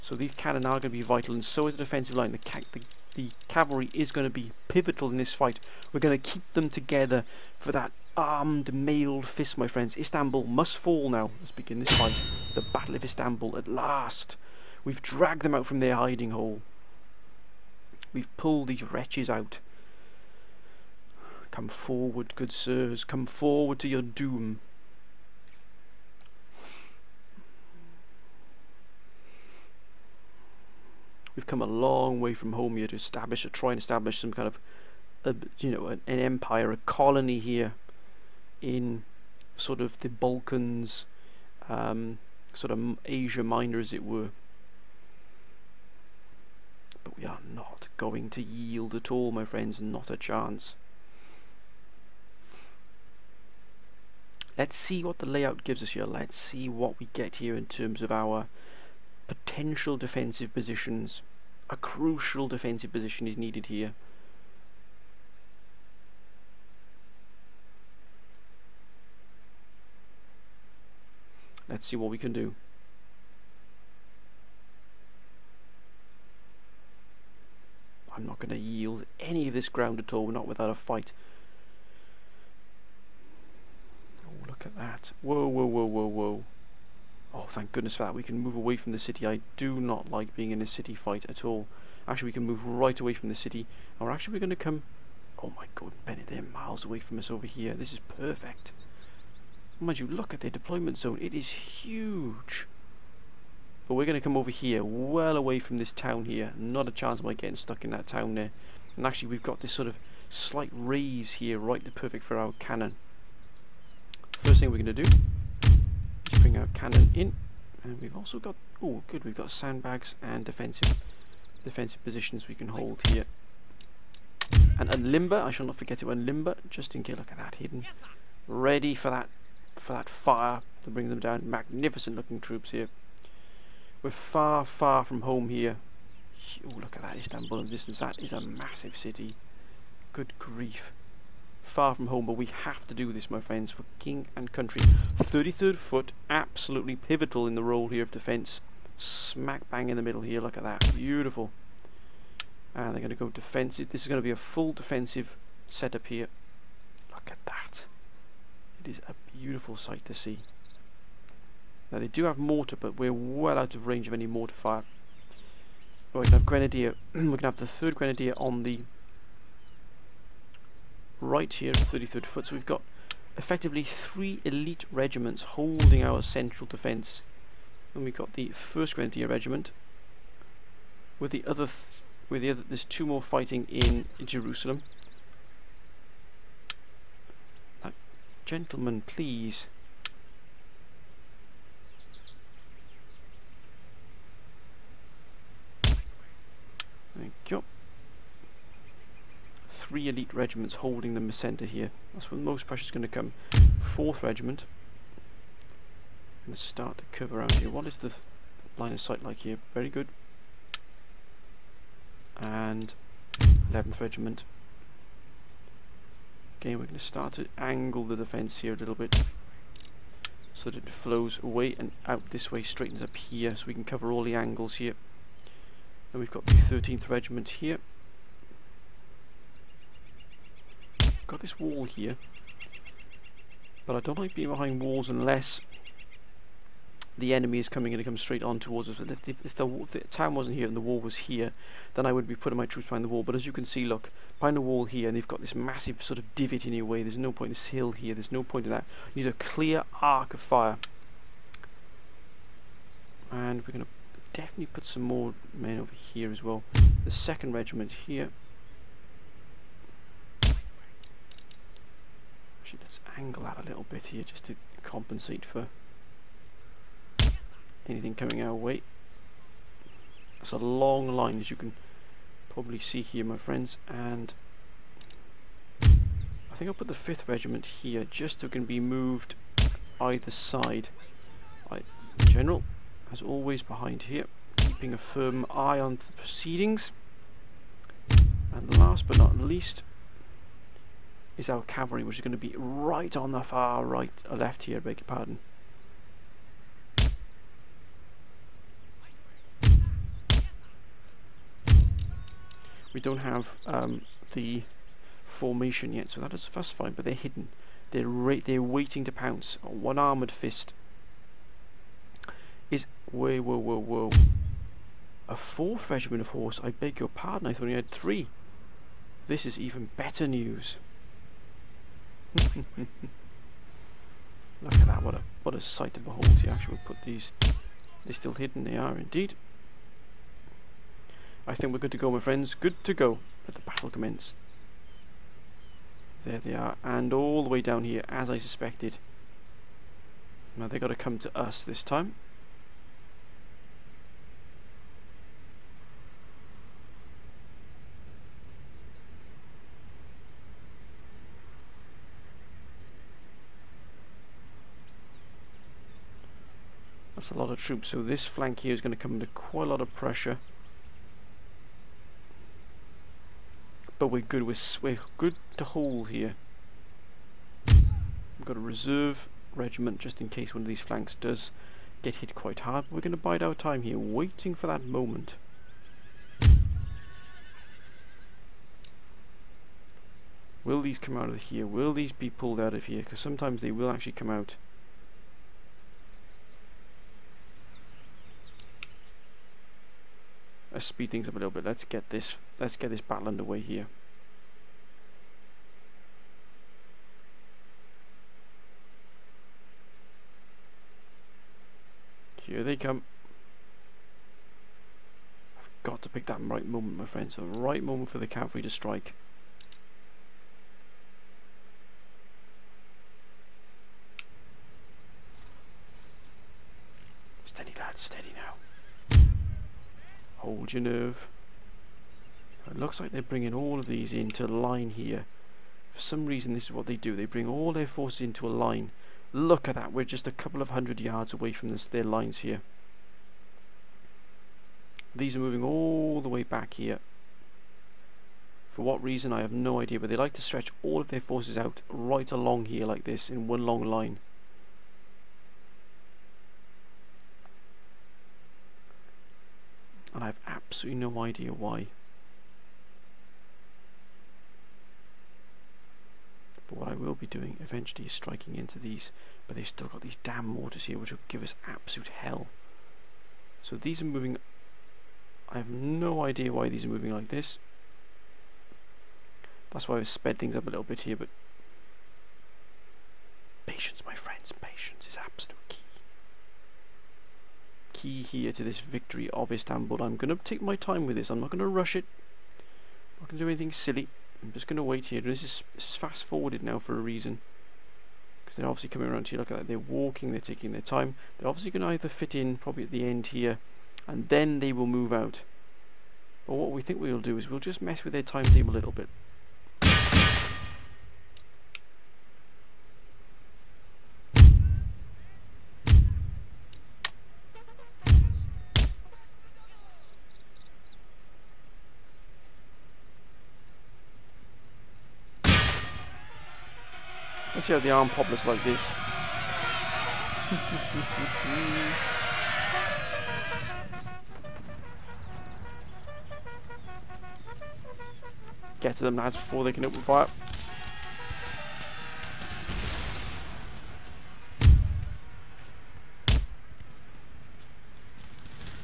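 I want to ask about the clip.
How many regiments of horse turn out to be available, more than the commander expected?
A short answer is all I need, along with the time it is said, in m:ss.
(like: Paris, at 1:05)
4, at 5:15.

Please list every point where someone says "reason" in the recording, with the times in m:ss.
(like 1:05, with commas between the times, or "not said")
7:06, 7:19, 8:07.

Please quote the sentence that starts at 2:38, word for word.
It is a beautiful sight to see.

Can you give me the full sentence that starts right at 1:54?
First thing we're going to do bring our cannon in.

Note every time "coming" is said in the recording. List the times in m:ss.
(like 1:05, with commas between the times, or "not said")
3:57, 4:28, 8:08.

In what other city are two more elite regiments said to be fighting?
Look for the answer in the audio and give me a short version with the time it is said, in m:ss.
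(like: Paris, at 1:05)
Jerusalem, at 3:04.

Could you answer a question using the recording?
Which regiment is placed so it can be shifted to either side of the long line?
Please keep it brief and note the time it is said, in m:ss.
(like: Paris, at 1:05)
5th Regiment, at 4:36.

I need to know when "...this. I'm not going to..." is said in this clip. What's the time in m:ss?
8:01.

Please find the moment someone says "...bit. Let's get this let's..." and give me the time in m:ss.
6:31.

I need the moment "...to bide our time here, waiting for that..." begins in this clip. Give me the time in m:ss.
6:13.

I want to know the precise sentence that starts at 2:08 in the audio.
Ready for that, for that fire to bring them down.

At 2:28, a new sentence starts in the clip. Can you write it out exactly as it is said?
Smack bang in the middle here, look at that, beautiful.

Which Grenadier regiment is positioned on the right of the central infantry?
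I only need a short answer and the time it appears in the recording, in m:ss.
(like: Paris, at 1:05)
3rd Grenadier, at 2:47.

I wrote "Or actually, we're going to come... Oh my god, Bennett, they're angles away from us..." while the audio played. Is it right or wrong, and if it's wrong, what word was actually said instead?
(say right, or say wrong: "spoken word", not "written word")
wrong: "miles", not "angles".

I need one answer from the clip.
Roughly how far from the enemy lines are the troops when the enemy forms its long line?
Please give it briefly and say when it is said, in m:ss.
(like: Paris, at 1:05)
a couple of hundred yards, at 7:10.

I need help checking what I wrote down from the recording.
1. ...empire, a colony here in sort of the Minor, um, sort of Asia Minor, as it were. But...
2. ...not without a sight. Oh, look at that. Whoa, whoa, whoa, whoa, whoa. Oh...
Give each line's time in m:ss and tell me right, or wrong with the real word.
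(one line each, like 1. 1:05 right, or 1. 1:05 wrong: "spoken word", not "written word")
1. 0:36 wrong: "Balkans", not "Minor"
2. 1:20 wrong: "fight", not "sight".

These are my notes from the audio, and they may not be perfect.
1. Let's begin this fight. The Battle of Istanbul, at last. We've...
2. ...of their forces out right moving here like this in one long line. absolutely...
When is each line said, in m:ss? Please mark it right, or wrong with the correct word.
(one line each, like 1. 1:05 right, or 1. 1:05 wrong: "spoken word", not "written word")
1. 0:11 right
2. 7:21 wrong: "along", not "moving".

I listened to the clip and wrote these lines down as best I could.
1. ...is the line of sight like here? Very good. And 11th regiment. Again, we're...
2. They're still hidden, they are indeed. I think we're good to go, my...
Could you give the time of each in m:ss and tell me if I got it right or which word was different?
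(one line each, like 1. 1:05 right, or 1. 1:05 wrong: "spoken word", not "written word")
1. 3:27 right
2. 5:28 right.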